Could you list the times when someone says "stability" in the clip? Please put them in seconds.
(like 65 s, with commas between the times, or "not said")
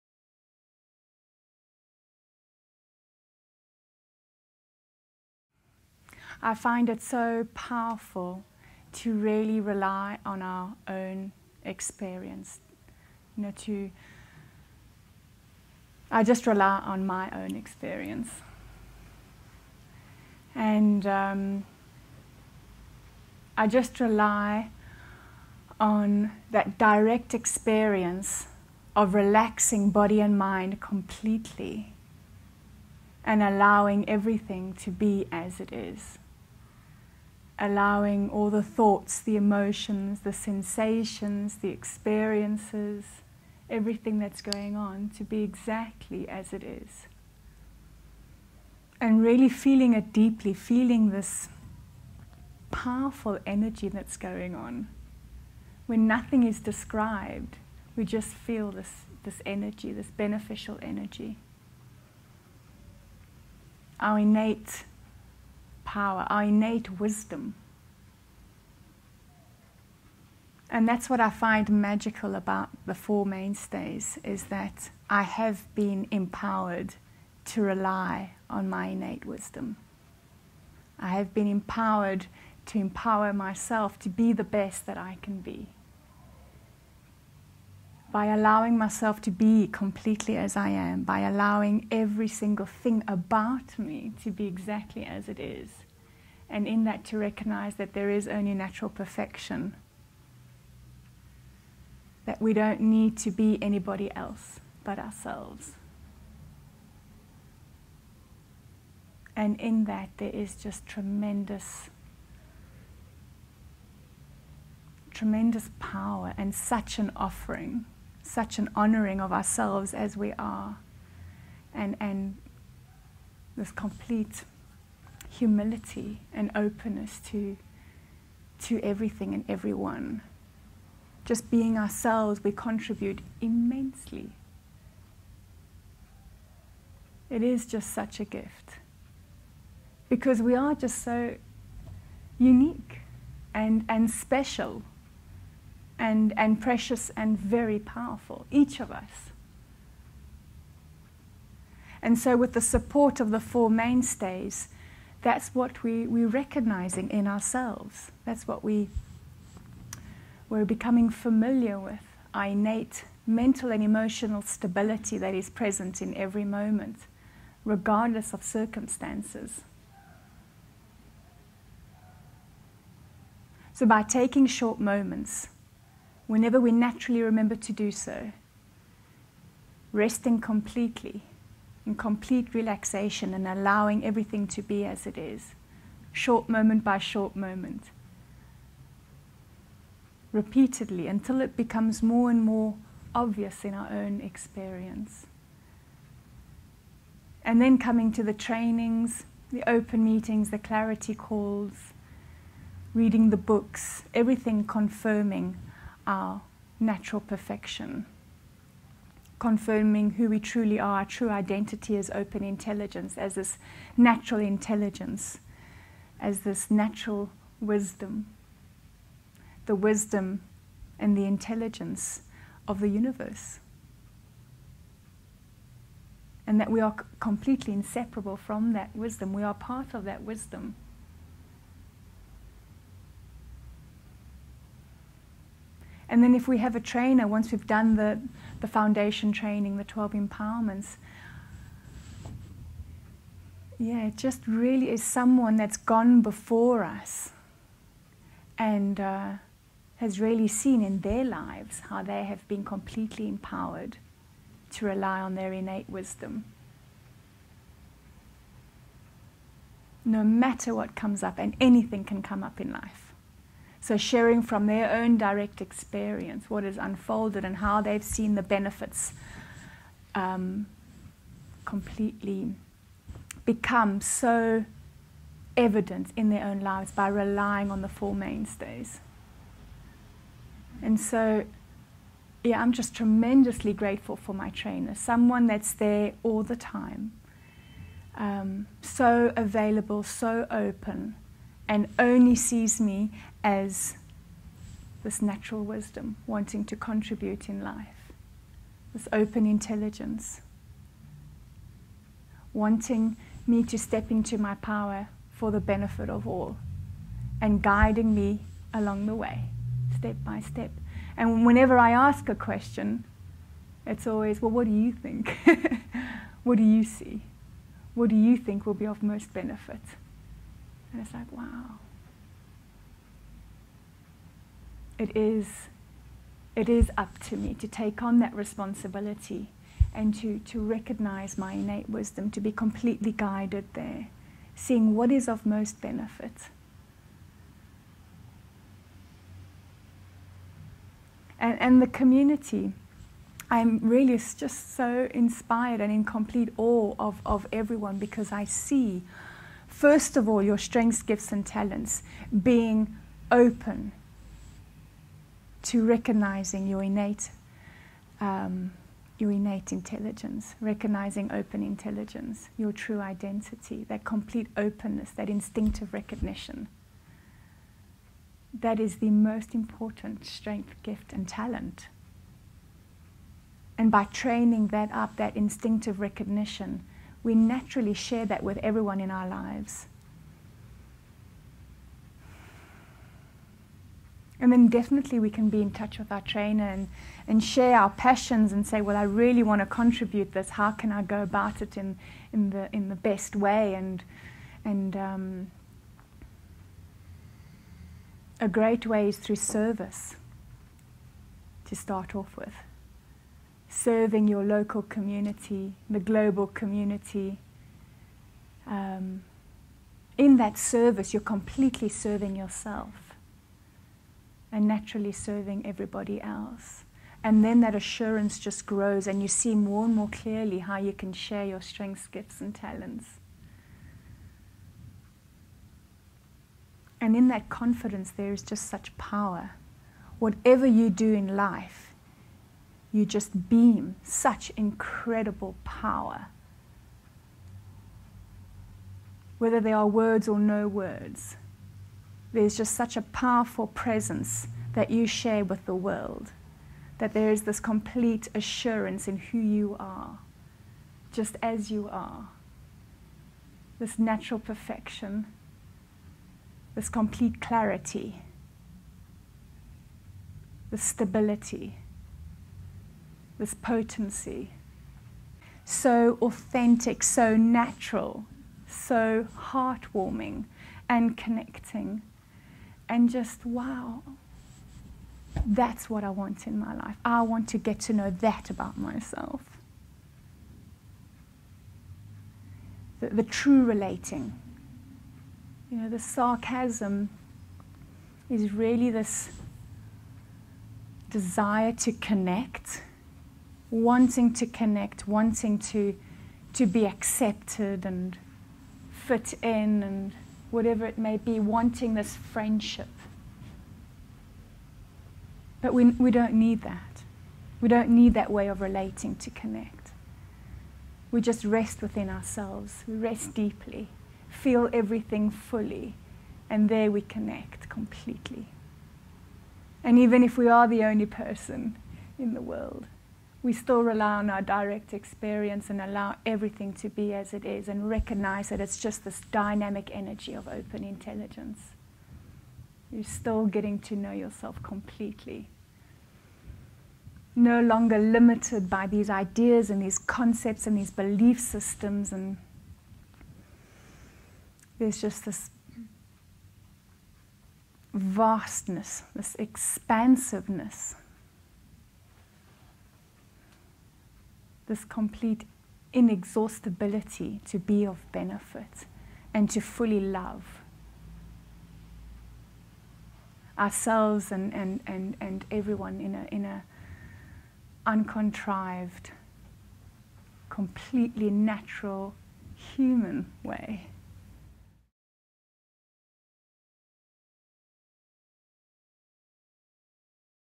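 164 s, 460 s.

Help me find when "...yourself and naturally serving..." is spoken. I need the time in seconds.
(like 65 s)
412 s.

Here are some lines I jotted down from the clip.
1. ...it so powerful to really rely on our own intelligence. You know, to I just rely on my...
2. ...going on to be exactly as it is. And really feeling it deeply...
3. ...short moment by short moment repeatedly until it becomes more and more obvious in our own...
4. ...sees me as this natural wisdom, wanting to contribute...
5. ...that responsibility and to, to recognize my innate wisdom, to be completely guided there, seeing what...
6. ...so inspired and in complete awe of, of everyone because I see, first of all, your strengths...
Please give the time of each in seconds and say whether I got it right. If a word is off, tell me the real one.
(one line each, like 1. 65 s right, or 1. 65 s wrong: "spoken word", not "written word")
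1. 6 s wrong: "experience", not "intelligence"
2. 44 s right
3. 186 s right
4. 292 s right
5. 328 s right
6. 344 s right.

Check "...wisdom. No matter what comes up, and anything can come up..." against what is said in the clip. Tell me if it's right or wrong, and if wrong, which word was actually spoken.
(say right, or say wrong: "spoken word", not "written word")
right.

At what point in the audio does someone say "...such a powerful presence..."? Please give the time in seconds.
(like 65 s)
442 s.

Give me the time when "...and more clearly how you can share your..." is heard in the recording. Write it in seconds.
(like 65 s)
419 s.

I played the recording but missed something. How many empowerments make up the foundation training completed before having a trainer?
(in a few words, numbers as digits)
12.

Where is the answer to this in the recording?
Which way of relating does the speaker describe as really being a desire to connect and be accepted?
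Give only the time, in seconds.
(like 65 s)
485 s.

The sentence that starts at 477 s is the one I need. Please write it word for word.
I want to get to know that about myself.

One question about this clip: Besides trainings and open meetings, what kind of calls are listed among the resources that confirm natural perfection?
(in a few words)
Clarity calls.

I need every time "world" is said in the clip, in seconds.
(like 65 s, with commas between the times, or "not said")
445 s, 522 s.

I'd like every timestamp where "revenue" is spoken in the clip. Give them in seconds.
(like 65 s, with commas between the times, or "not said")
not said.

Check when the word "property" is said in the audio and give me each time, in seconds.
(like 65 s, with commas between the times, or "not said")
not said.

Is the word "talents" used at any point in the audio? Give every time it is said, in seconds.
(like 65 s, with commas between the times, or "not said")
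351 s, 371 s, 422 s.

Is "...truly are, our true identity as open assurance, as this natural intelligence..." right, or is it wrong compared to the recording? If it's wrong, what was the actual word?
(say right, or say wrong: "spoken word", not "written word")
wrong: "intelligence", not "assurance".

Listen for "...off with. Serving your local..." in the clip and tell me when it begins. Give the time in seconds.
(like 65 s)
402 s.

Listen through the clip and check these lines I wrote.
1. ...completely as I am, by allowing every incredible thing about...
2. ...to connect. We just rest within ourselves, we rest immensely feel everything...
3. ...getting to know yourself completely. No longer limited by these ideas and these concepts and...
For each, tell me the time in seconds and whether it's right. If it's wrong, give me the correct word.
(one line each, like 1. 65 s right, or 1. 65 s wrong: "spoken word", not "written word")
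1. 89 s wrong: "single", not "incredible"
2. 509 s wrong: "deeply", not "immensely"
3. 533 s right.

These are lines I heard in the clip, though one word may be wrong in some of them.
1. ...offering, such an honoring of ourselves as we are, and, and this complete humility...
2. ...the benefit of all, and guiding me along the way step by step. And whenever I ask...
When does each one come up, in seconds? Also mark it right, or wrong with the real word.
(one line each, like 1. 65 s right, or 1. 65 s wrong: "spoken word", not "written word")
1. 117 s right
2. 305 s right.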